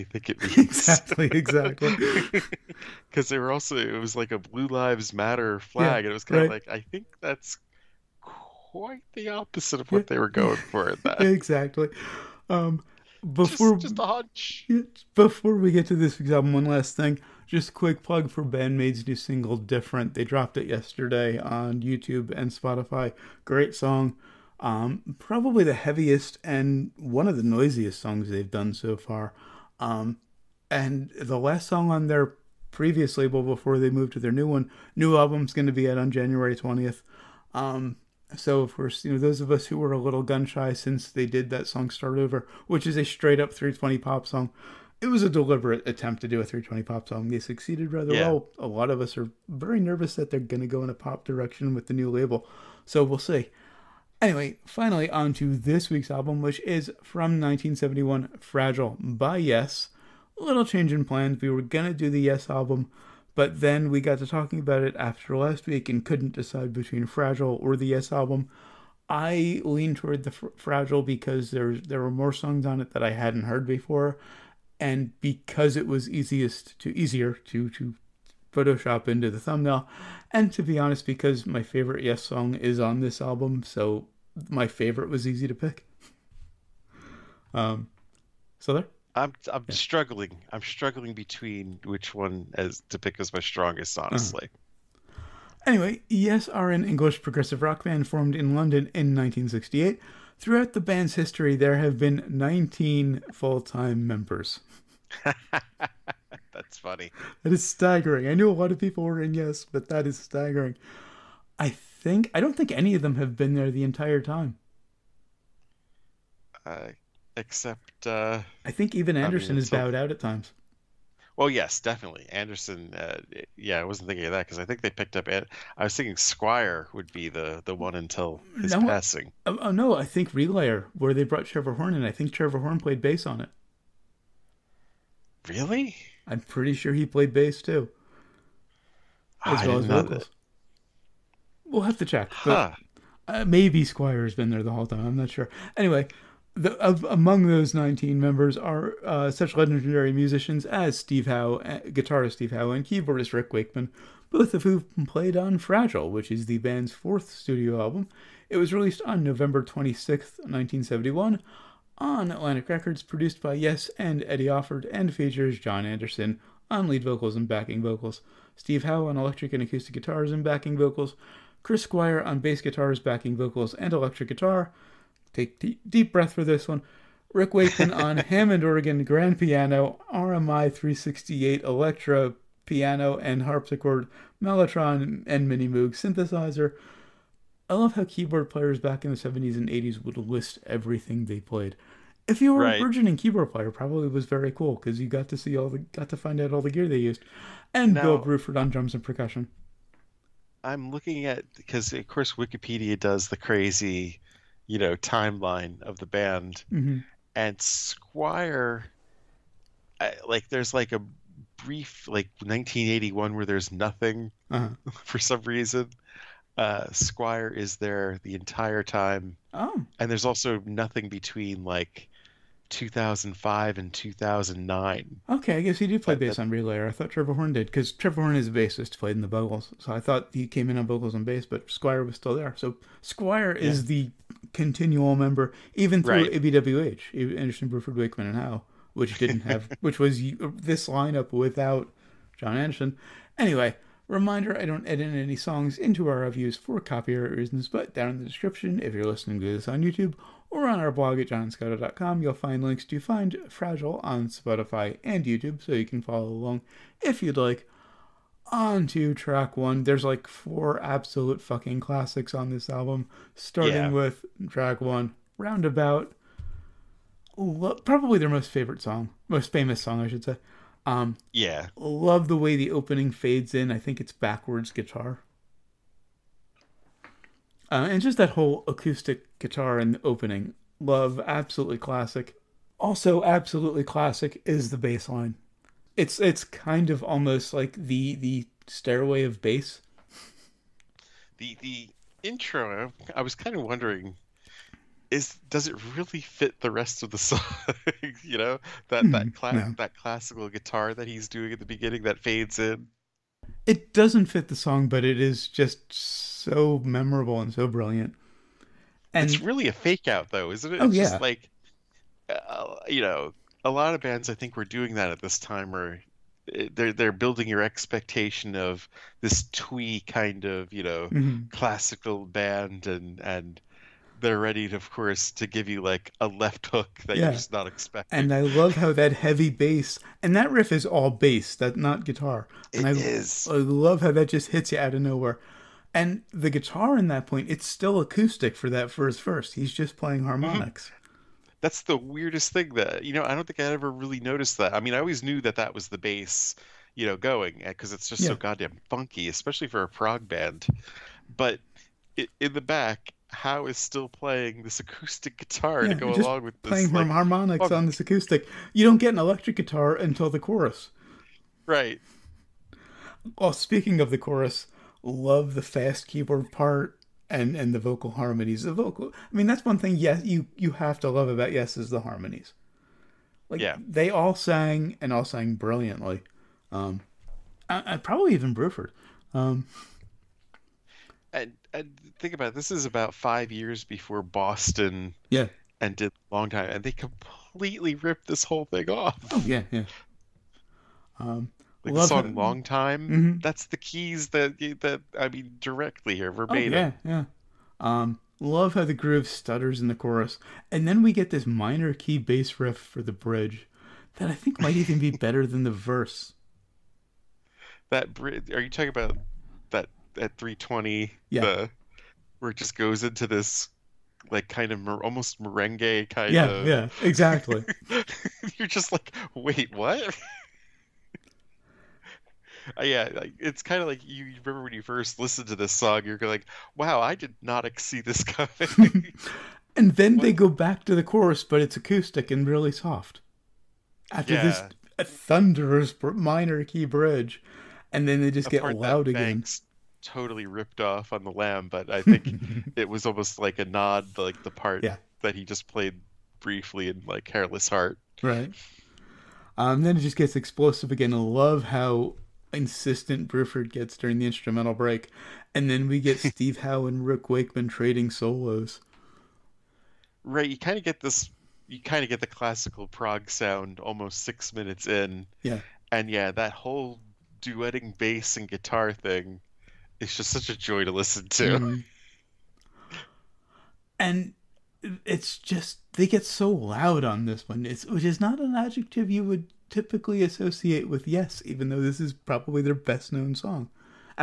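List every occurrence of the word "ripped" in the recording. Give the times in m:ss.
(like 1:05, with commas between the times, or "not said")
6:27, 7:20.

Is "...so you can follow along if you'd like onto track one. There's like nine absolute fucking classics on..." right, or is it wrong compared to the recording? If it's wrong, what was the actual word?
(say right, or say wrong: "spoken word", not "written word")
wrong: "four", not "nine".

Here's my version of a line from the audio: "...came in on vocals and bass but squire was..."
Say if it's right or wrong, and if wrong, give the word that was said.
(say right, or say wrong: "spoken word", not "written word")
right.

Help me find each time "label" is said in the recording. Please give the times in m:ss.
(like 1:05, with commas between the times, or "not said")
0:33, 0:52.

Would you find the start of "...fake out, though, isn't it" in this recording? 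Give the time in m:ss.
5:09.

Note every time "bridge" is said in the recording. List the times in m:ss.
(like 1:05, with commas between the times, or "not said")
6:43, 6:48, 7:16.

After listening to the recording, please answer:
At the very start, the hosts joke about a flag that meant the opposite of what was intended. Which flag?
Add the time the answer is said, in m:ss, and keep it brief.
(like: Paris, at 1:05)
Blue Lives Matter, at 0:04.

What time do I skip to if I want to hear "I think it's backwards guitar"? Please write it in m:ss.
4:33.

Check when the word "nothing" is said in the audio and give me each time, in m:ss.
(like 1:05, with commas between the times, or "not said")
3:33, 3:40.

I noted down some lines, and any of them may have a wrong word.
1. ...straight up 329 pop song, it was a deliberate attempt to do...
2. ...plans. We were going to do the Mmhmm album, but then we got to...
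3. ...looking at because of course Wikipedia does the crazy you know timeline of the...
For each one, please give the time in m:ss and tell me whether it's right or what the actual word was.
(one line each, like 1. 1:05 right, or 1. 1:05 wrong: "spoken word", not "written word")
1. 0:43 wrong: "320", not "329"
2. 1:01 wrong: "Yes", not "Mmhmm"
3. 3:20 right.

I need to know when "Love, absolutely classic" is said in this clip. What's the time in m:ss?
4:40.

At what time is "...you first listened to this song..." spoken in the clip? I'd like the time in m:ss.
7:04.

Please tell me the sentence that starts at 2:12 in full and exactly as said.
I think Trevor Horn played bass on it.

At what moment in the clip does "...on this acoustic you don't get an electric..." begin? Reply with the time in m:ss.
5:57.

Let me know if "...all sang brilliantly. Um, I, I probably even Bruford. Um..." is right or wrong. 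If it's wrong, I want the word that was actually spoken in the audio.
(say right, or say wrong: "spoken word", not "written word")
right.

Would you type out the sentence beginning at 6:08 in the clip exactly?
The vocal, I mean, that's one thing.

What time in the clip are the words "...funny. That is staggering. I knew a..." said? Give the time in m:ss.
1:46.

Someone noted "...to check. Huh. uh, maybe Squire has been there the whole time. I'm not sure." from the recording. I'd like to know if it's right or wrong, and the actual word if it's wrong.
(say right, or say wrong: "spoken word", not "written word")
right.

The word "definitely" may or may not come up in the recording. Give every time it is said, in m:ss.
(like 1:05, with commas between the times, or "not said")
2:01.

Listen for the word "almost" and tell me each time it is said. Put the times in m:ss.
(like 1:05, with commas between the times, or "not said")
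4:47, 6:55, 7:23, 7:43.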